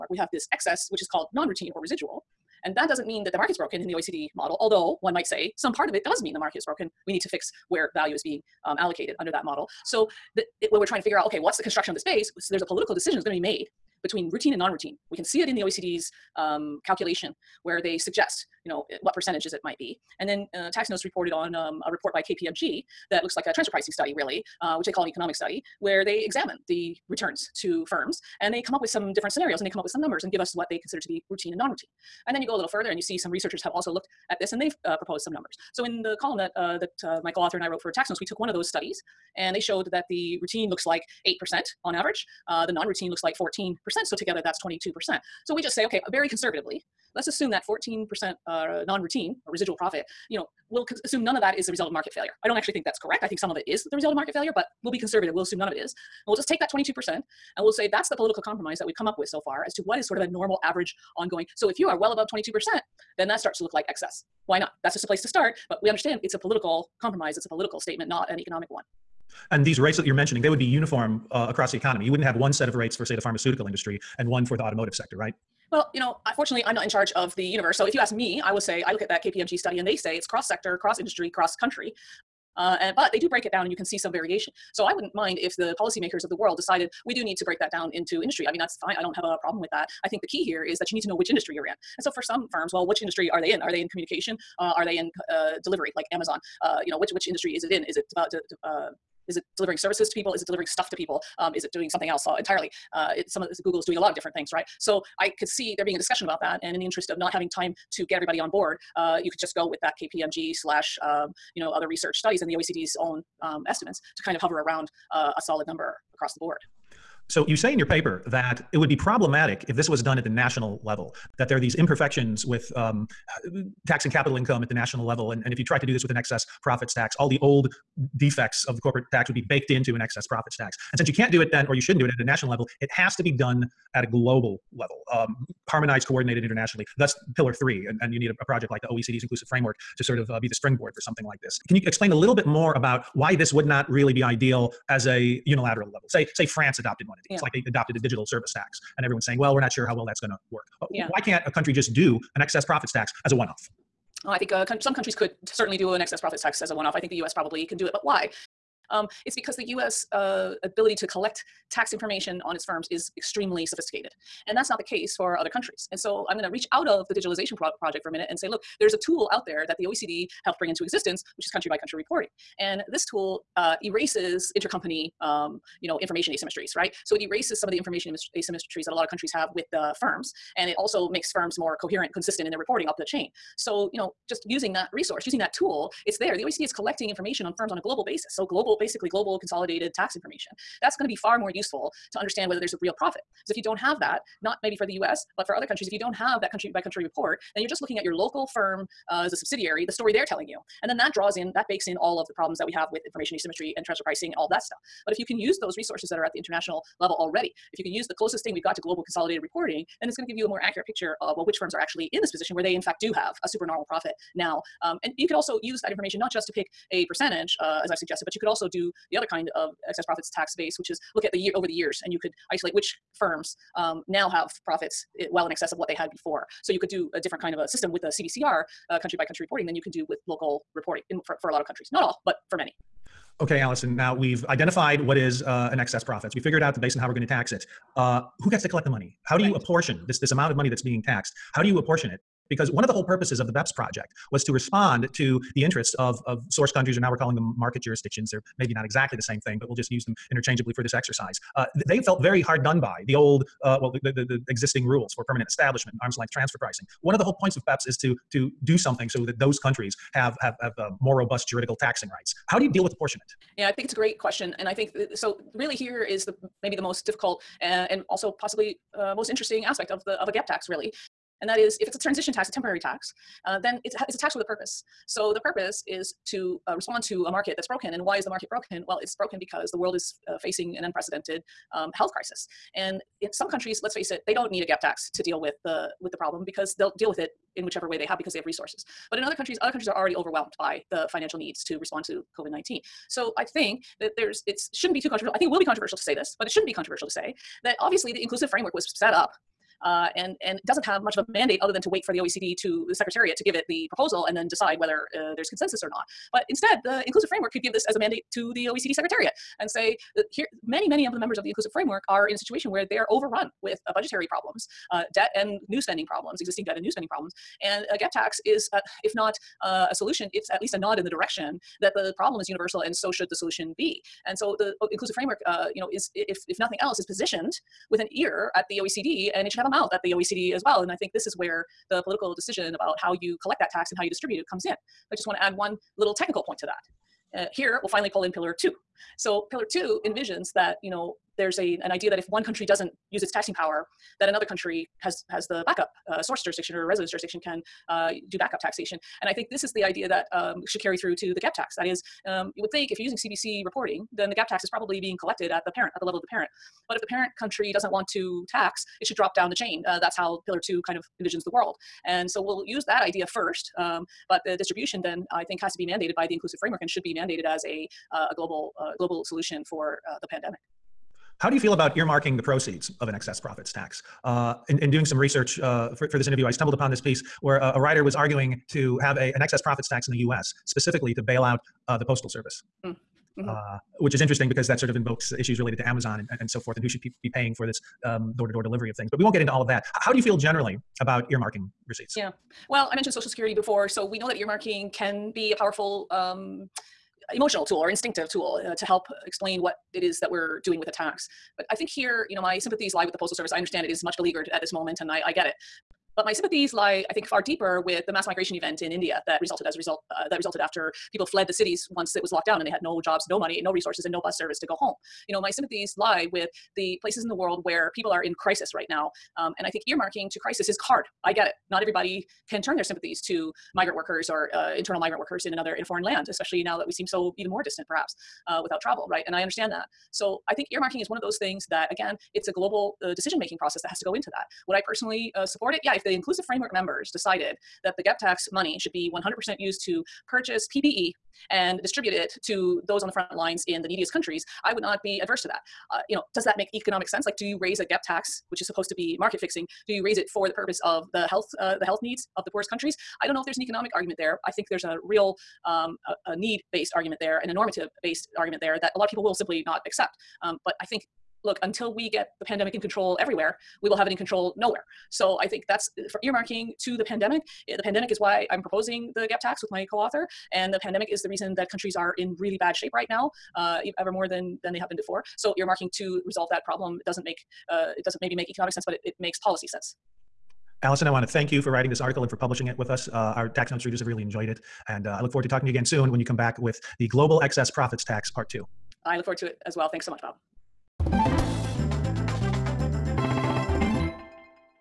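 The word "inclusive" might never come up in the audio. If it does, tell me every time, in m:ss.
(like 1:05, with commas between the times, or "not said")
2:19, 4:58, 5:07, 5:11, 5:24, 6:06, 7:16.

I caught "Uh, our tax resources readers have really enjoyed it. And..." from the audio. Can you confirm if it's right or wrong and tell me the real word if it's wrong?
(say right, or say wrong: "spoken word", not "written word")
wrong: "notes", not "resources".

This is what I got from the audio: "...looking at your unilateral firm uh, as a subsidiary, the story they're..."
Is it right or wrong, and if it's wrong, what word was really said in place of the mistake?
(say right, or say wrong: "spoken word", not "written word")
wrong: "local", not "unilateral".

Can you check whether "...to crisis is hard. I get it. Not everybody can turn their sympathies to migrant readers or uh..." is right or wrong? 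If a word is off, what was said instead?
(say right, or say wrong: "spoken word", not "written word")
wrong: "workers", not "readers".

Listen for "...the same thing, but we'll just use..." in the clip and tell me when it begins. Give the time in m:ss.
4:09.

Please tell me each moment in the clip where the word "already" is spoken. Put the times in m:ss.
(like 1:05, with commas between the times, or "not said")
3:27, 4:49.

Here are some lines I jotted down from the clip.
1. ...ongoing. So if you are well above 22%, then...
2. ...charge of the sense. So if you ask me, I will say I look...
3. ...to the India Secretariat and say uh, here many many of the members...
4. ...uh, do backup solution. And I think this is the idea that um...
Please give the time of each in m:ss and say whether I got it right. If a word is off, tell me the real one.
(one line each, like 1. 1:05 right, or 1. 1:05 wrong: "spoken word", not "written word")
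1. 1:01 right
2. 1:16 wrong: "universe", not "sense"
3. 5:08 wrong: "OECD", not "India"
4. 5:47 wrong: "taxation", not "solution".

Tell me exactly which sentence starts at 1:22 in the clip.
Uh, and, but they do break it down and you can see some variation.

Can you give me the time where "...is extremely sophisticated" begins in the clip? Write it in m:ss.
2:42.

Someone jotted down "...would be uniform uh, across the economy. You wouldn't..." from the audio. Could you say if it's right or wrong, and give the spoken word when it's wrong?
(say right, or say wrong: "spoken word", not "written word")
right.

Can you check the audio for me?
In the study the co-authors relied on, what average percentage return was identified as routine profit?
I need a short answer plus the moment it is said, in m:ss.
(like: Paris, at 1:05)
8%, at 0:41.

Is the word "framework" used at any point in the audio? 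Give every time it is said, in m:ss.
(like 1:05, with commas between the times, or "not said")
2:19, 4:58, 5:07, 5:11, 5:25, 6:06, 7:16.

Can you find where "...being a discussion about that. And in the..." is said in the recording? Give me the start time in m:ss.
1:45.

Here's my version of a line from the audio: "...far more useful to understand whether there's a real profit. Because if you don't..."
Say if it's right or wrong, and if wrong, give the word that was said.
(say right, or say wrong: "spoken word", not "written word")
right.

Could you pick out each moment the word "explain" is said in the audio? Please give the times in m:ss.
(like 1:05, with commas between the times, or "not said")
2:21, 6:39.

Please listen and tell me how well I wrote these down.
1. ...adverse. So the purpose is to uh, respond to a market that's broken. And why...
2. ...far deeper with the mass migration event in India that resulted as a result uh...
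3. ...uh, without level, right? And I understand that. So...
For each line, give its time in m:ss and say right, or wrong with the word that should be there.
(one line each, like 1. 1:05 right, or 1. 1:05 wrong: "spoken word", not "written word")
1. 4:34 wrong: "purpose", not "adverse"
2. 6:47 right
3. 7:08 wrong: "travel", not "level".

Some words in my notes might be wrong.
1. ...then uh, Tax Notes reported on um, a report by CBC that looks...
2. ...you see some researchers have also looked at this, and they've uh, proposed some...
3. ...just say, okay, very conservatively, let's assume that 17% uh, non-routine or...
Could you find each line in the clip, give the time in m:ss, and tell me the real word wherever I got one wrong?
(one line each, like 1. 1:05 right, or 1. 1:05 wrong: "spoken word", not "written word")
1. 0:20 wrong: "KPMG", not "CBC"
2. 0:32 right
3. 0:45 wrong: "14", not "17".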